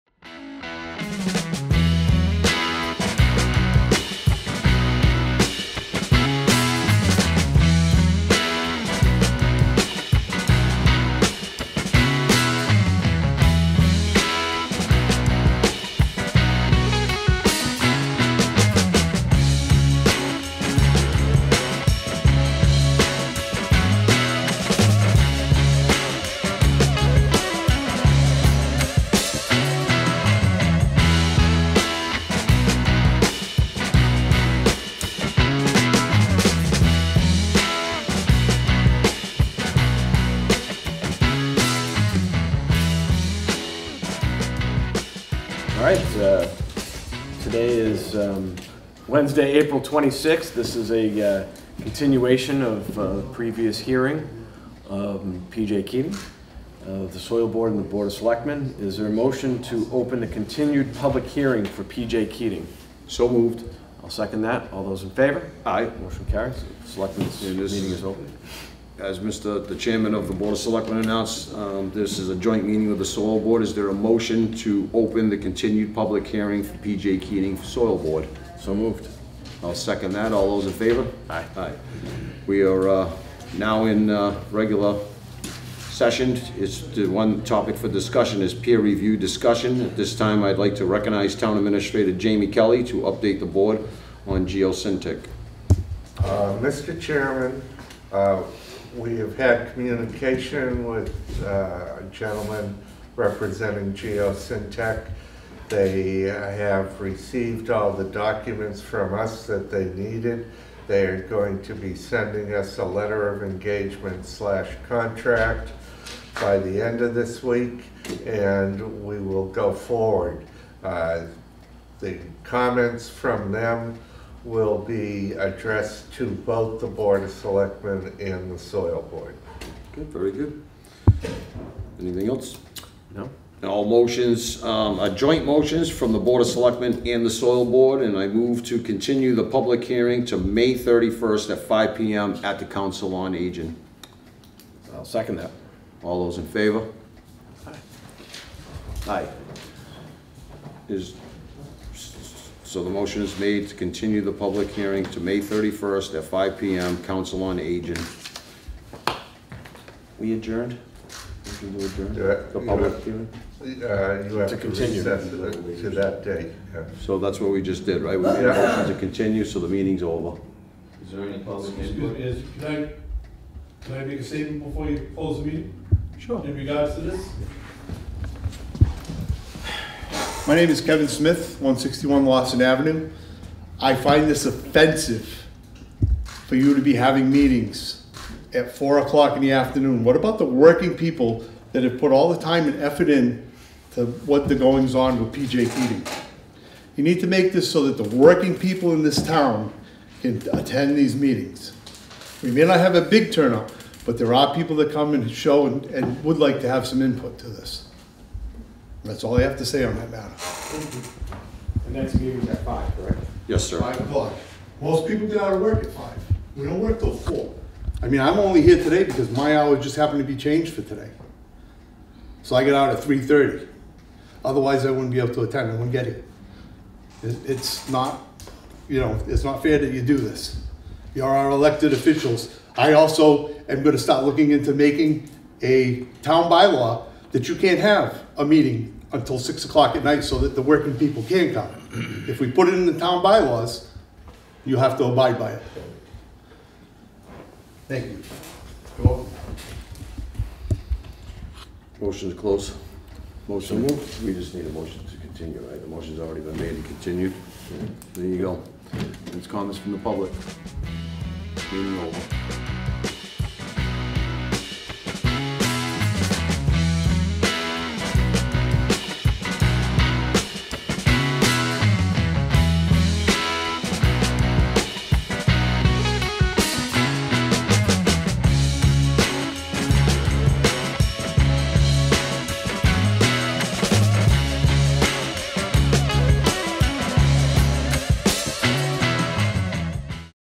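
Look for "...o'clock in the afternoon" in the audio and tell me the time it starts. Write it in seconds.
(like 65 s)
188 s.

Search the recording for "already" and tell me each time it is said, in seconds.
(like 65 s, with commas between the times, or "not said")
256 s.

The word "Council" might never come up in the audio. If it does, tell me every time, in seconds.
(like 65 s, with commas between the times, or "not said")
142 s, 157 s.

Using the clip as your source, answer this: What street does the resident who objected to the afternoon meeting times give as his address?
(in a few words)
Lawson Avenue.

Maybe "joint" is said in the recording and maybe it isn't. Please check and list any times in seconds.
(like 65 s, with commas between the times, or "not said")
72 s, 135 s.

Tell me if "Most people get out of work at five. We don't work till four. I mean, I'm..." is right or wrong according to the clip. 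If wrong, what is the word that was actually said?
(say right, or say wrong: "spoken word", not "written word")
right.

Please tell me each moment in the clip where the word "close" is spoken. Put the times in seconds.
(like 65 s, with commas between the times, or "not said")
175 s, 252 s.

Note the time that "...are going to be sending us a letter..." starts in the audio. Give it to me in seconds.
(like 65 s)
111 s.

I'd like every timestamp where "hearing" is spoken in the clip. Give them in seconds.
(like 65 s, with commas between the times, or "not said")
53 s, 61 s, 76 s, 139 s, 154 s, 163 s.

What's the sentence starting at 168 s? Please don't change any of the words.
We made a motion to continue, so the meeting's over.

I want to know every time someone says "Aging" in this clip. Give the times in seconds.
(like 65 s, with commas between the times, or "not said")
143 s, 157 s.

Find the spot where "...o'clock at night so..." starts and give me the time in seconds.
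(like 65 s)
239 s.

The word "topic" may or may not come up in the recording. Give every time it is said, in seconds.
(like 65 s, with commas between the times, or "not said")
87 s.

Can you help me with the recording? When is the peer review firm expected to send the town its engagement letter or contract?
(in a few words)
end of this week.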